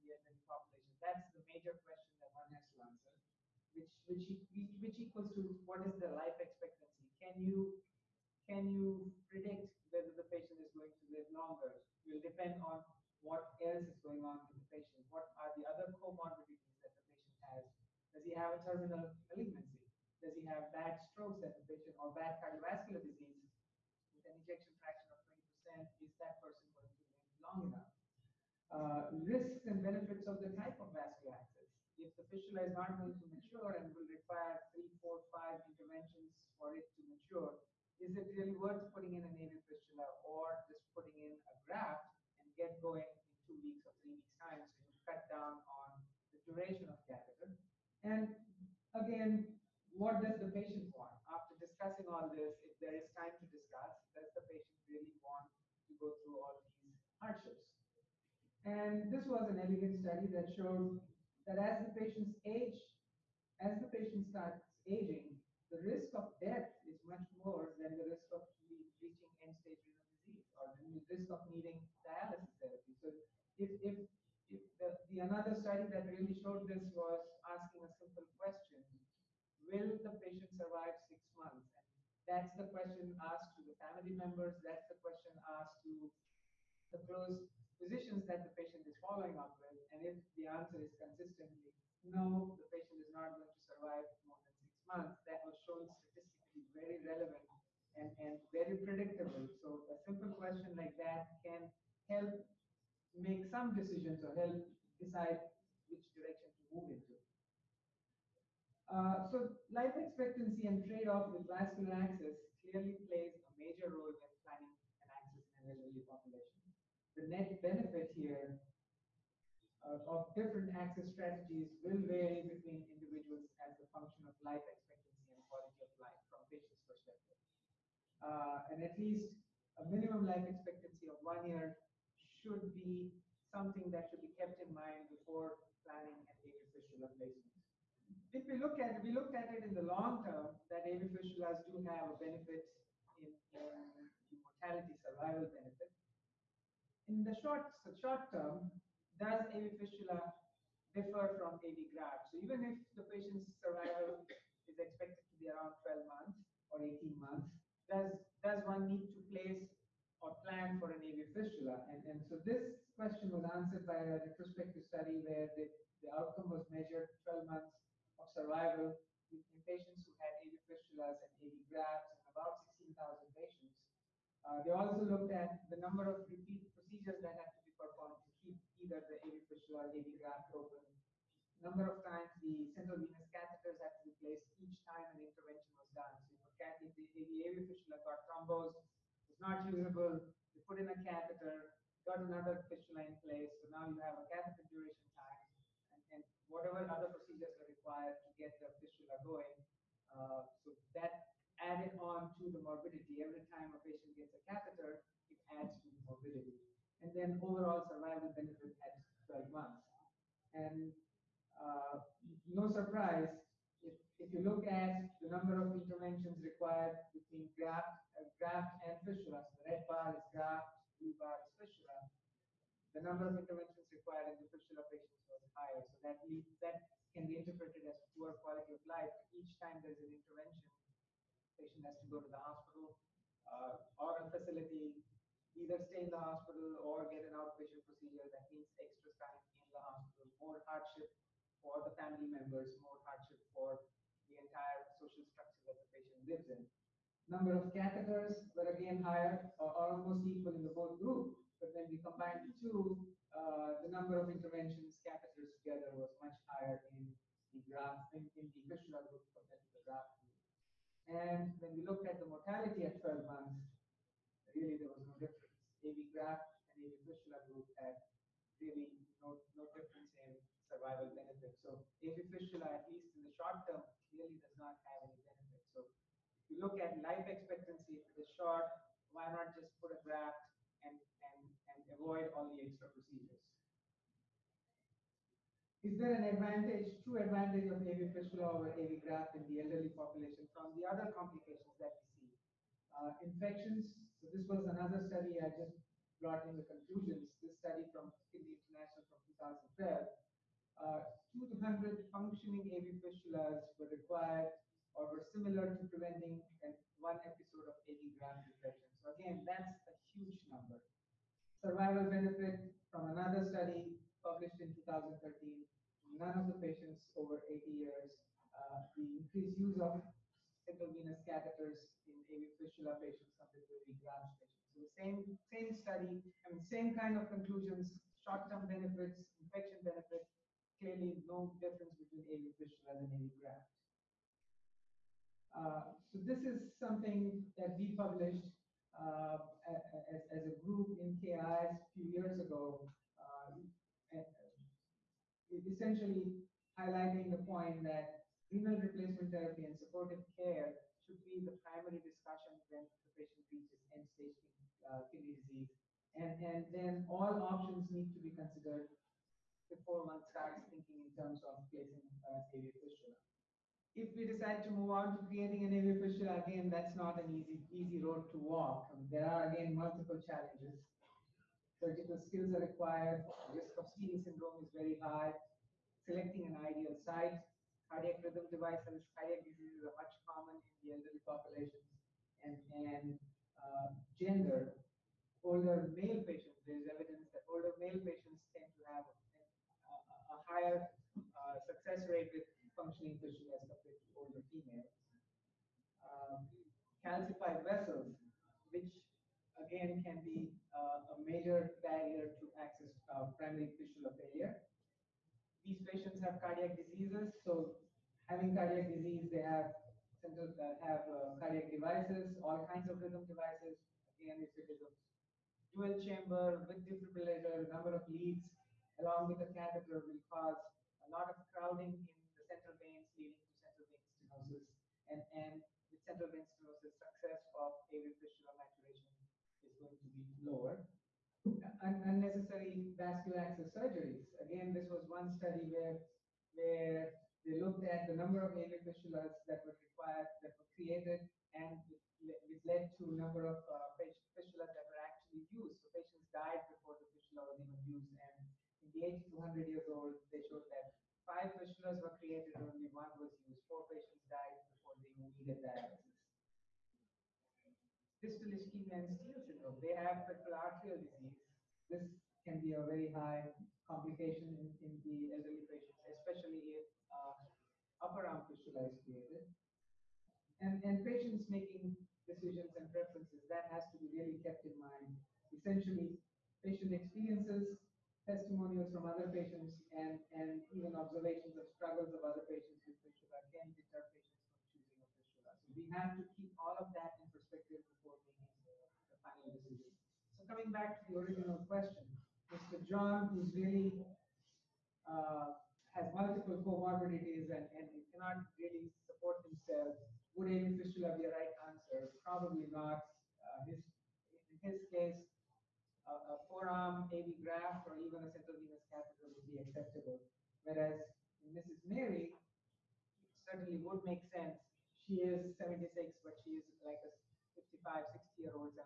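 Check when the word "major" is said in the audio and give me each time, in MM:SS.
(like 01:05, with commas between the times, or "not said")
00:01, 01:53, 06:41.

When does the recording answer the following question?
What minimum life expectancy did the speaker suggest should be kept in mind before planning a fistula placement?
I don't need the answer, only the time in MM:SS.
02:11.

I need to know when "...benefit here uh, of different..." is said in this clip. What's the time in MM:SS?
01:57.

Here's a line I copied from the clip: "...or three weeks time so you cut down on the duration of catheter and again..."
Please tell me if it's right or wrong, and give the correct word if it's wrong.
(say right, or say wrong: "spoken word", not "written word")
right.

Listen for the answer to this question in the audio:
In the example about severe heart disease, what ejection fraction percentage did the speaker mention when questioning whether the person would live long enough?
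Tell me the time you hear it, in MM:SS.
00:25.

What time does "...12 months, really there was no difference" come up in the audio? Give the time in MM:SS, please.
04:22.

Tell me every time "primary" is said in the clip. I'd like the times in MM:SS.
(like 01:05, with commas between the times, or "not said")
05:51, 06:43.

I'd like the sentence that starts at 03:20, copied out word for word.
Uh, so that added on to the morbidity.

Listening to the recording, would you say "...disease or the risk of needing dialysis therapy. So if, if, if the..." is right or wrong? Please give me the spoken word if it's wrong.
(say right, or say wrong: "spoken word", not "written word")
right.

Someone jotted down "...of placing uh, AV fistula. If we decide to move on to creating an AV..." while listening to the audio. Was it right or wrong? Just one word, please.
right.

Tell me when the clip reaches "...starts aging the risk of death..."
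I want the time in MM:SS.
01:04.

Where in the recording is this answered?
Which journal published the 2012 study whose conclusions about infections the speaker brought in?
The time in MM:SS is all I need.
04:58.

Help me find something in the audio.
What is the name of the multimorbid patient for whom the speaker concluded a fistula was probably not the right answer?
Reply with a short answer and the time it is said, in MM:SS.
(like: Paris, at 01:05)
Mr. John, at 08:12.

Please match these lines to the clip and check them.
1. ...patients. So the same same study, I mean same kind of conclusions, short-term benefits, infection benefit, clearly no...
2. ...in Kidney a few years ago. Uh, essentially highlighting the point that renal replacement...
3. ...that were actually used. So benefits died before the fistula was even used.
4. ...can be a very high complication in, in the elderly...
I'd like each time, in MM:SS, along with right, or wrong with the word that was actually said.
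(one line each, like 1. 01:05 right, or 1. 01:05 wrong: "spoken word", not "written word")
1. 05:24 right
2. 05:40 wrong: "KIS", not "Kidney"
3. 07:24 wrong: "patients", not "benefits"
4. 07:42 right.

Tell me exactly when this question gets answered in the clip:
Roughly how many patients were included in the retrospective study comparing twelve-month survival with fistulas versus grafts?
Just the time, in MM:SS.
02:52.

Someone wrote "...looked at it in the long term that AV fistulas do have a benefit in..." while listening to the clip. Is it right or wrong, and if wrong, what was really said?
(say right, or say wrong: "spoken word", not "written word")
right.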